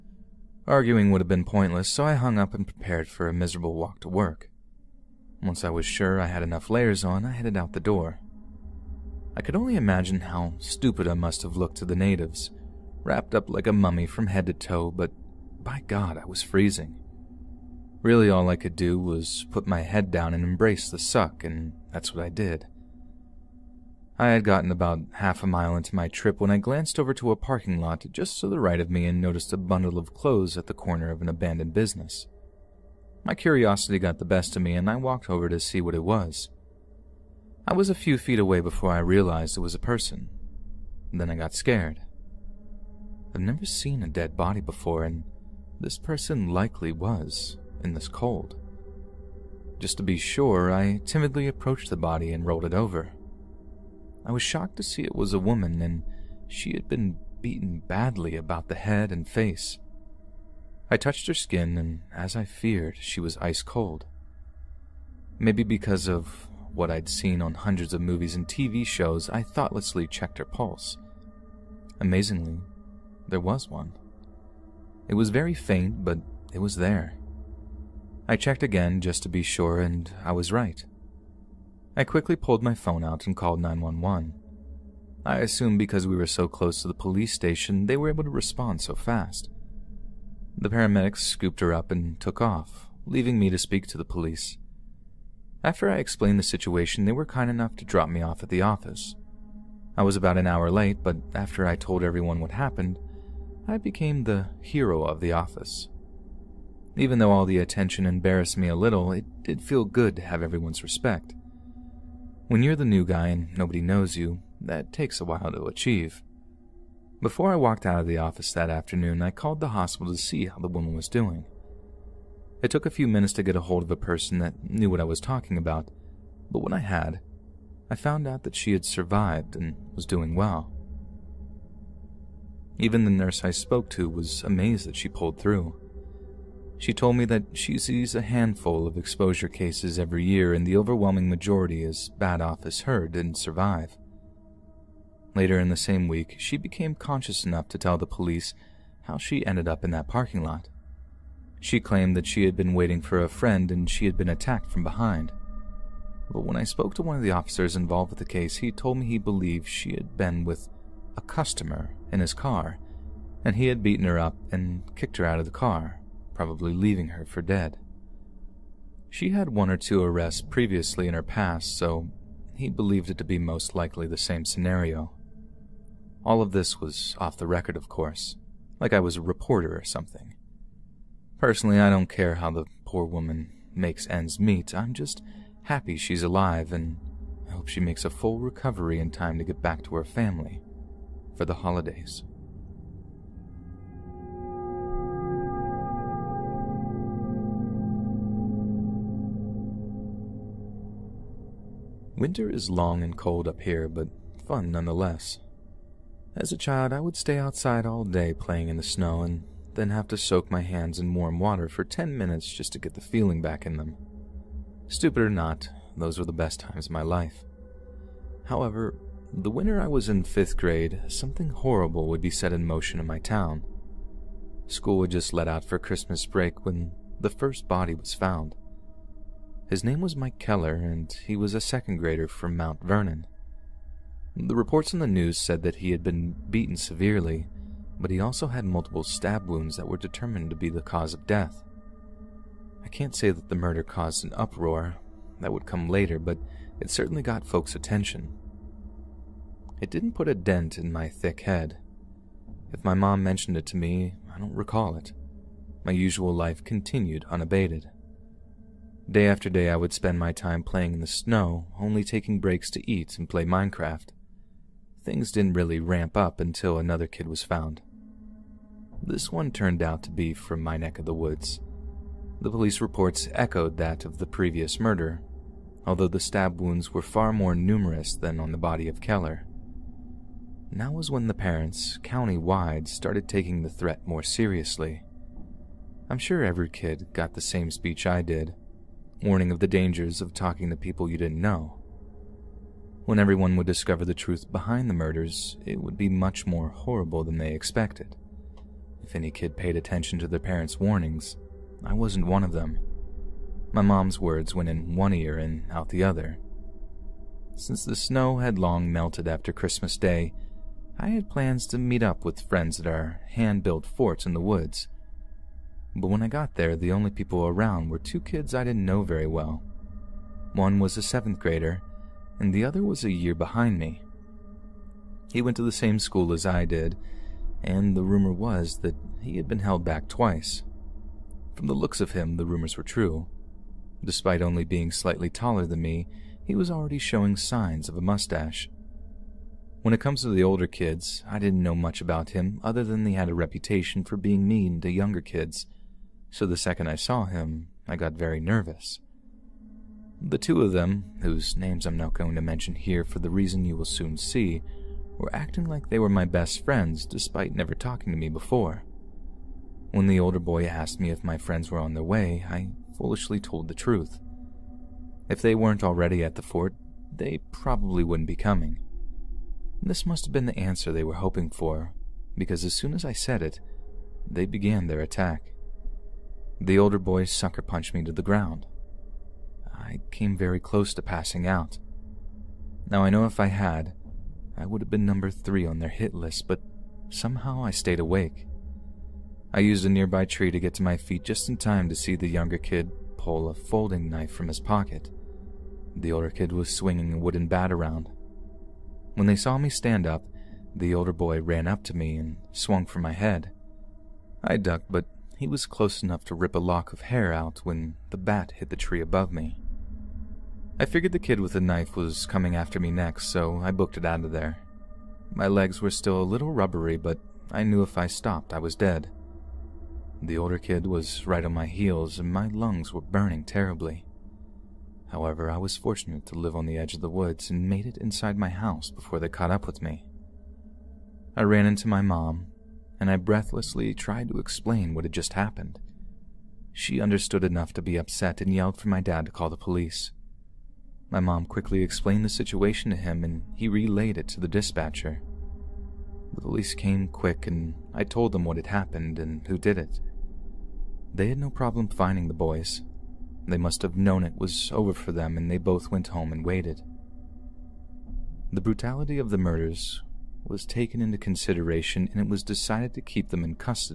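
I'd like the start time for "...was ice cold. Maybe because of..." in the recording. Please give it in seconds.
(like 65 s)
63 s.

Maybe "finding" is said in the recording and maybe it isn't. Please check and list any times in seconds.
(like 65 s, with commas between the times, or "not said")
451 s.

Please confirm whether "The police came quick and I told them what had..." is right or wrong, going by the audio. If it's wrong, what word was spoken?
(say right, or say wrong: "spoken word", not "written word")
right.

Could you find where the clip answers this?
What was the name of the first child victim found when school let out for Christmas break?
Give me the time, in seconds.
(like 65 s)
230 s.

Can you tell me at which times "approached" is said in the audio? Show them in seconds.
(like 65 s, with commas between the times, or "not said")
51 s.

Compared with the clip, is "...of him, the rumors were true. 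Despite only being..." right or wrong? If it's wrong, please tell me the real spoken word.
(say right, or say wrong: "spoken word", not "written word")
right.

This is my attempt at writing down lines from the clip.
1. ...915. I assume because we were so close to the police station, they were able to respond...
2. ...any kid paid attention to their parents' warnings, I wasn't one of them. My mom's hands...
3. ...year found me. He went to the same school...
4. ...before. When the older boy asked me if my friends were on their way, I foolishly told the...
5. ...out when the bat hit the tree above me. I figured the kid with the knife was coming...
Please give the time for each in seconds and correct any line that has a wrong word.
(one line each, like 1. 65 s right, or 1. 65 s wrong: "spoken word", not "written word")
1. 83 s wrong: "911", not "915"
2. 299 s wrong: "words", not "hands"
3. 323 s wrong: "behind", not "found"
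4. 358 s right
5. 407 s right.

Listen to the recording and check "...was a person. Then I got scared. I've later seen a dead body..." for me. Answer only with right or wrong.
wrong.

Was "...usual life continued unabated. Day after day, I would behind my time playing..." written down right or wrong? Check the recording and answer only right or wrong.
wrong.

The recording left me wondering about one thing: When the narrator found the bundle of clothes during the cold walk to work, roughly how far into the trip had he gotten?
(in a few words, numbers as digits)
half a mile.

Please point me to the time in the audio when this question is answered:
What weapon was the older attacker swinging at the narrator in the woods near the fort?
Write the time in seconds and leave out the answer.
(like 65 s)
397 s.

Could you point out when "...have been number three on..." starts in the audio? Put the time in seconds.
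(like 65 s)
384 s.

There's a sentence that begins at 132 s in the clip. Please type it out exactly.
Even the nurse I spoke to was amazed that she pulled through.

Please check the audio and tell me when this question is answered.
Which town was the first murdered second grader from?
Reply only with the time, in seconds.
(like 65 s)
232 s.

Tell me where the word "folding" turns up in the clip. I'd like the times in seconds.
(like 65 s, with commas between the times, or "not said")
393 s.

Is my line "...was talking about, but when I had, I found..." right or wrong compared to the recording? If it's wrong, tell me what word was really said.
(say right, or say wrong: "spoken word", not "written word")
right.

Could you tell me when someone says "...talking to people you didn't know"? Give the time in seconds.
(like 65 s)
290 s.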